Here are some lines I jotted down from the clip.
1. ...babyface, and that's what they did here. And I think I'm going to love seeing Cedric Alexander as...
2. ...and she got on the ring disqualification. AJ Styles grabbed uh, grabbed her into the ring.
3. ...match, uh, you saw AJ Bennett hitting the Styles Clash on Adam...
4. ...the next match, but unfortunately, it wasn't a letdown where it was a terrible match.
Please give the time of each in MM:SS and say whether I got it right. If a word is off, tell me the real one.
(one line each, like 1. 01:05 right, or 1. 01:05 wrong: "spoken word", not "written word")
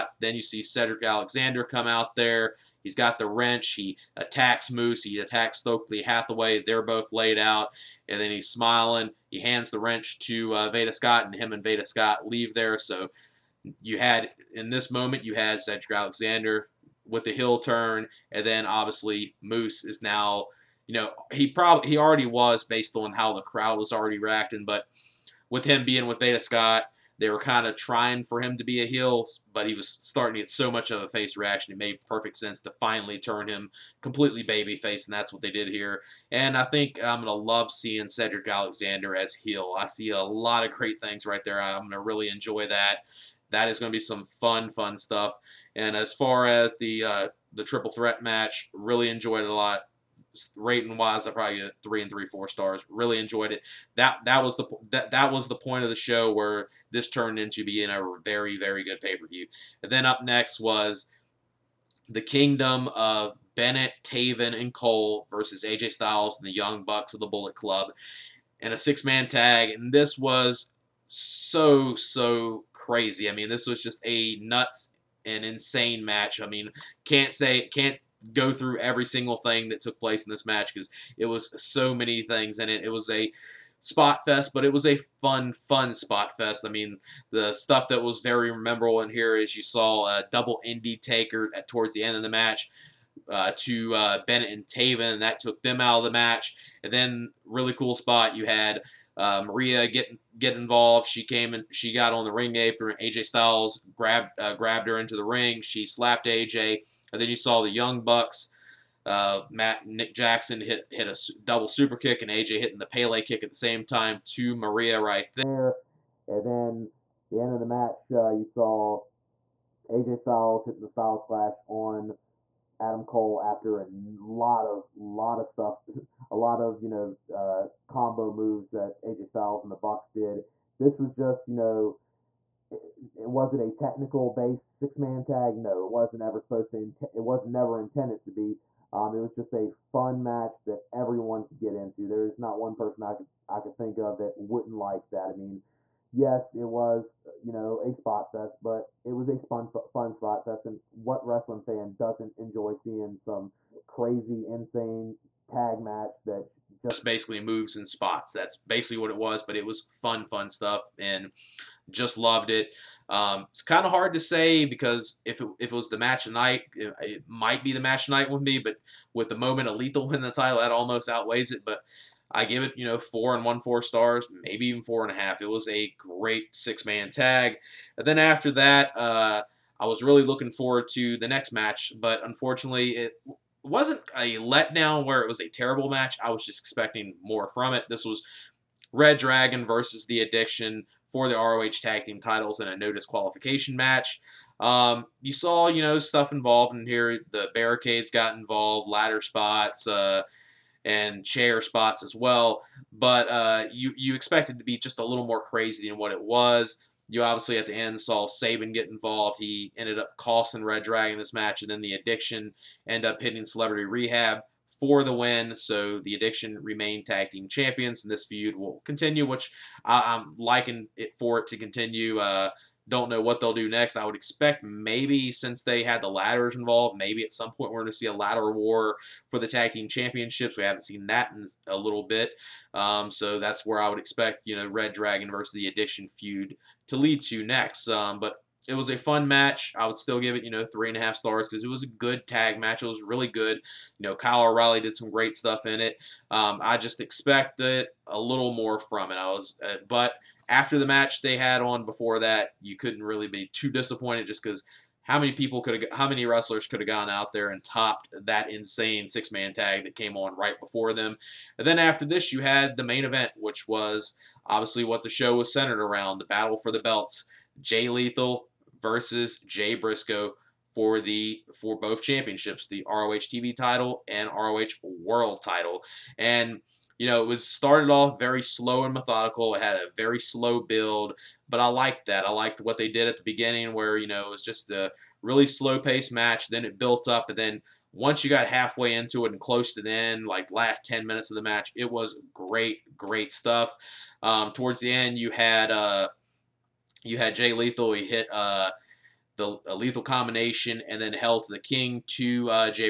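1. 00:34 right
2. 01:41 wrong: "apron", not "disqualification"
3. 01:57 wrong: "Styles", not "Bennett"
4. 03:01 right.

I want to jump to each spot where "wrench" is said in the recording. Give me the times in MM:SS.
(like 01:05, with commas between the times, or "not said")
00:03, 00:09.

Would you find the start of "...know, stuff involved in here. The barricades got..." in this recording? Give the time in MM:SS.
03:15.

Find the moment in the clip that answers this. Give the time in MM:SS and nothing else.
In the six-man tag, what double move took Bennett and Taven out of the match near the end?
01:30.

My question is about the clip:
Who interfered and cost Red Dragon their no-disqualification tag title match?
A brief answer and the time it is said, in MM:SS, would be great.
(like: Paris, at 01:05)
Saban, at 03:28.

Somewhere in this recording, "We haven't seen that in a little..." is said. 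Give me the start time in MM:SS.
03:50.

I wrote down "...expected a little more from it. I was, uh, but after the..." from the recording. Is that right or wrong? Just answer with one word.
right.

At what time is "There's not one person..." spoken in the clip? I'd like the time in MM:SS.
02:22.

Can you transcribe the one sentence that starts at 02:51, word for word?
But I give it, you know, four and one four stars, maybe even four and a half.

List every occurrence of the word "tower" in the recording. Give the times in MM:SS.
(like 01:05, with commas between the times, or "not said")
not said.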